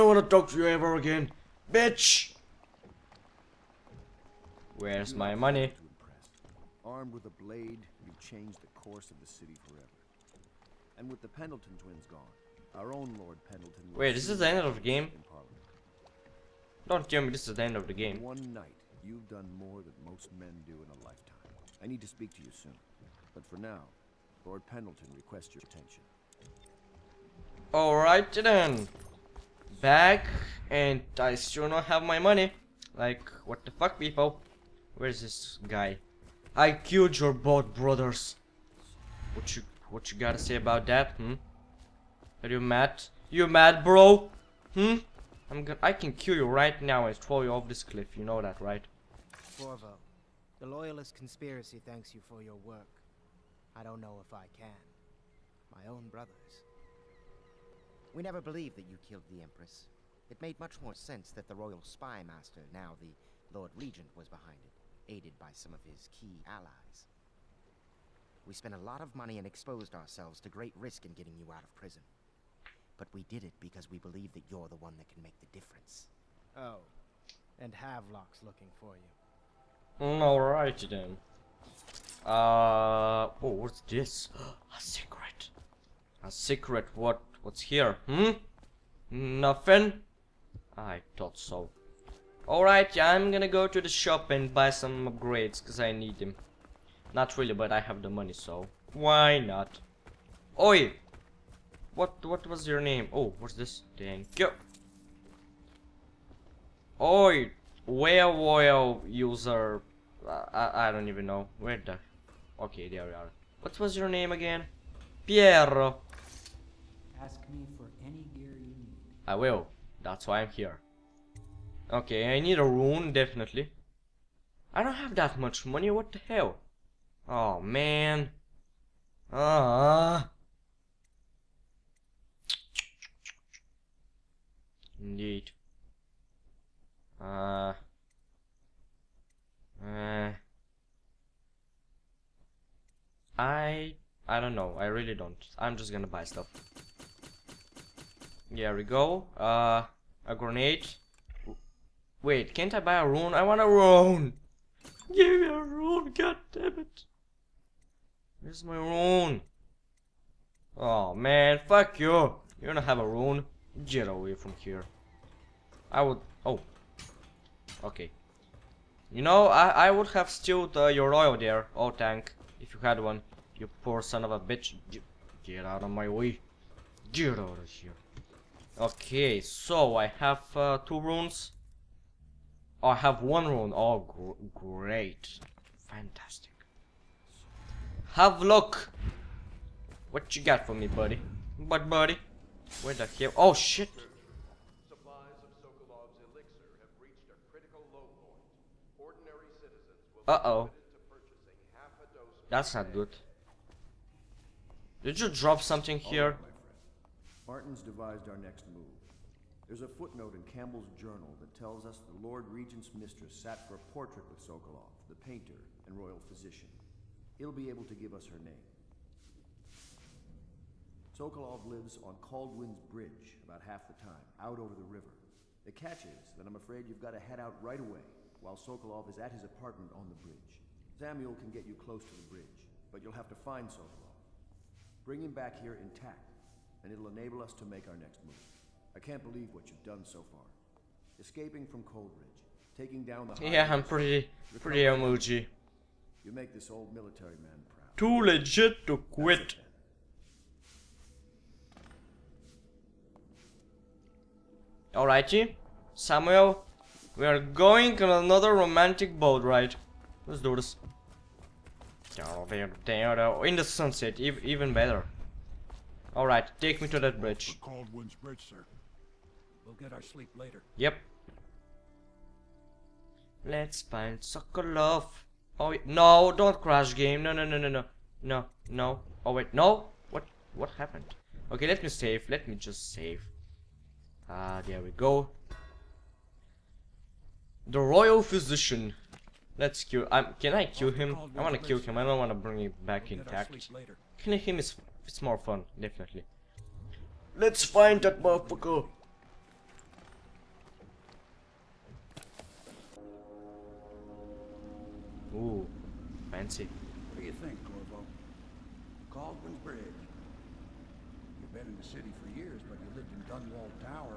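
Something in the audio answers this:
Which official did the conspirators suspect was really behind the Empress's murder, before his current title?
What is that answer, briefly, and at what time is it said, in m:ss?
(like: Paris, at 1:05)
Royal spy master, at 1:01.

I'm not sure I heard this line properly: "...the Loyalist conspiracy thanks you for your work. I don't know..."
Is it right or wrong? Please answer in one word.
right.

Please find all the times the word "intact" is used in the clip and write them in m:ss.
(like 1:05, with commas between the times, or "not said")
3:55, 4:53.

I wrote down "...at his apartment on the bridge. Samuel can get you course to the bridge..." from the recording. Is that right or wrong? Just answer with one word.
wrong.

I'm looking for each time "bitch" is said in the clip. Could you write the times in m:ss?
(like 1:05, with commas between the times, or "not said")
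0:01, 2:54.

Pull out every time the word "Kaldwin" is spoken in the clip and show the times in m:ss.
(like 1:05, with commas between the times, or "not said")
3:42, 5:09.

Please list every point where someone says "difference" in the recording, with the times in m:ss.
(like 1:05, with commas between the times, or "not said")
1:15.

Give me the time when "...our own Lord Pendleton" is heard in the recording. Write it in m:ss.
0:12.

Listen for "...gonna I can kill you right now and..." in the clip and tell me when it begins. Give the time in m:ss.
0:45.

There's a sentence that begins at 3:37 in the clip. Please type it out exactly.
He'll be able to give us her name.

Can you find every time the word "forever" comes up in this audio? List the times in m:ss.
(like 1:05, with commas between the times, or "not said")
0:09.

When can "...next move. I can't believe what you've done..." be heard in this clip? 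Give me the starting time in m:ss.
3:57.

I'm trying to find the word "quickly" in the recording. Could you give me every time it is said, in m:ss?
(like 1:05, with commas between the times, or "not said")
not said.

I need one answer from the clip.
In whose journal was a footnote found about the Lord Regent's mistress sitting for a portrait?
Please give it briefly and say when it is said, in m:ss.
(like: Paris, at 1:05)
Campbell, at 3:30.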